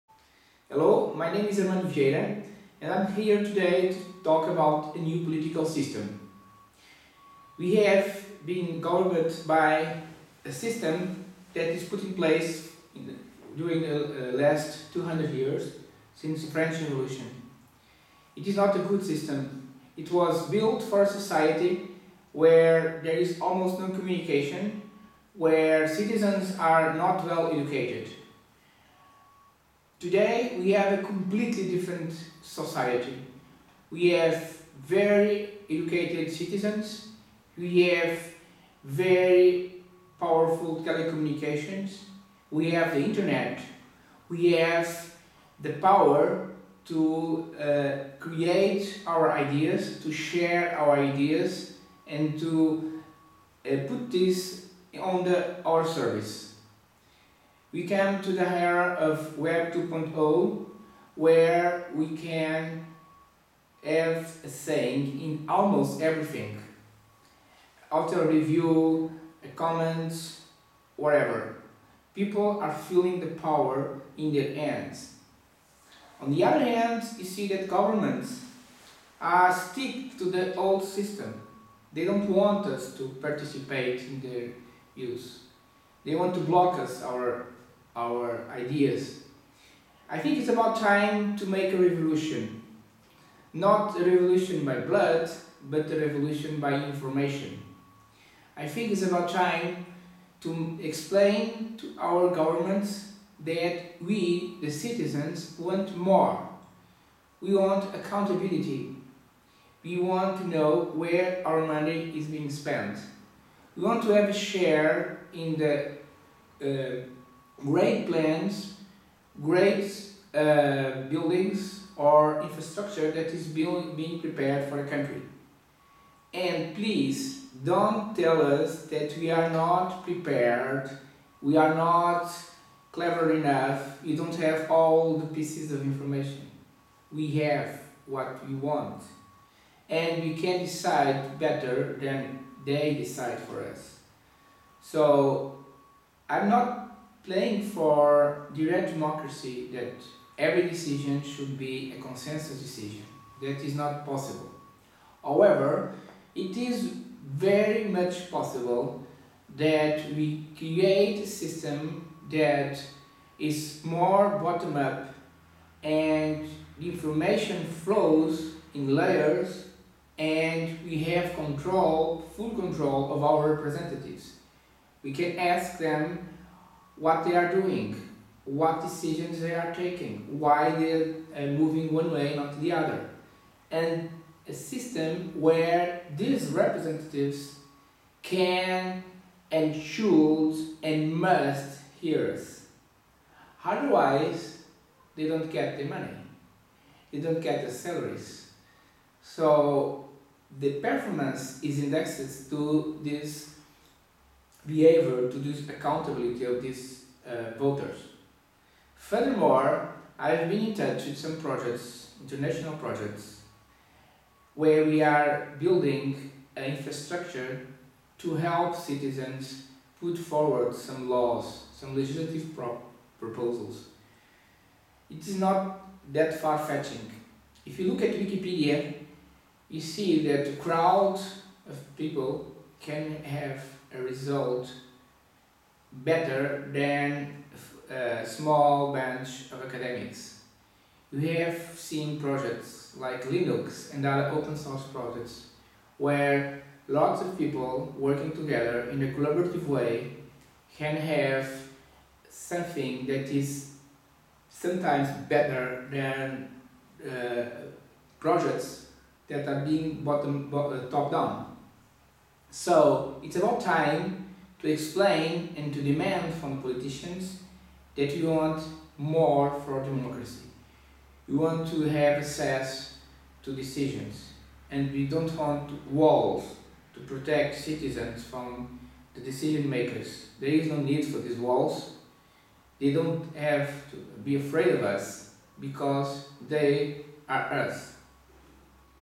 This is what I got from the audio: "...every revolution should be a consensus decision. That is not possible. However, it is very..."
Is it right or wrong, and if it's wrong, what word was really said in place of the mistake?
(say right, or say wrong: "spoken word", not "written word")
wrong: "decision", not "revolution".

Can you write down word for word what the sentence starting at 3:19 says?
So the performance is indexed to this behavior to this accountability of these uh, voters.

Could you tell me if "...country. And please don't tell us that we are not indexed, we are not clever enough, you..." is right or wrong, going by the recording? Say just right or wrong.
wrong.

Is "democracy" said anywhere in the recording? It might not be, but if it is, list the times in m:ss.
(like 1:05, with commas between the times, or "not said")
2:28, 4:29.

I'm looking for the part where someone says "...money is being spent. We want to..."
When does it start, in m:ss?
1:51.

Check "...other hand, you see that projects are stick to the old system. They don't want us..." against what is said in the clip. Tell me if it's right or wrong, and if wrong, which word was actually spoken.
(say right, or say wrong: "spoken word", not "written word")
wrong: "governments", not "projects".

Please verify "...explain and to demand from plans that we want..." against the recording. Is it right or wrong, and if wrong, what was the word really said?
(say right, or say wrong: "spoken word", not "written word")
wrong: "politicians", not "plans".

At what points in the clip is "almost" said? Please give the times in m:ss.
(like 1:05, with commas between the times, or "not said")
0:23, 1:05.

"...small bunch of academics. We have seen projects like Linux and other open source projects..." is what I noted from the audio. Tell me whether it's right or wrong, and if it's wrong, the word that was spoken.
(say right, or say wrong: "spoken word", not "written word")
right.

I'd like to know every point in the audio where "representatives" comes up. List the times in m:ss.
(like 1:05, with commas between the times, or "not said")
2:53, 3:06.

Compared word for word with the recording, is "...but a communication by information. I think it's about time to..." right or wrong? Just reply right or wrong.
wrong.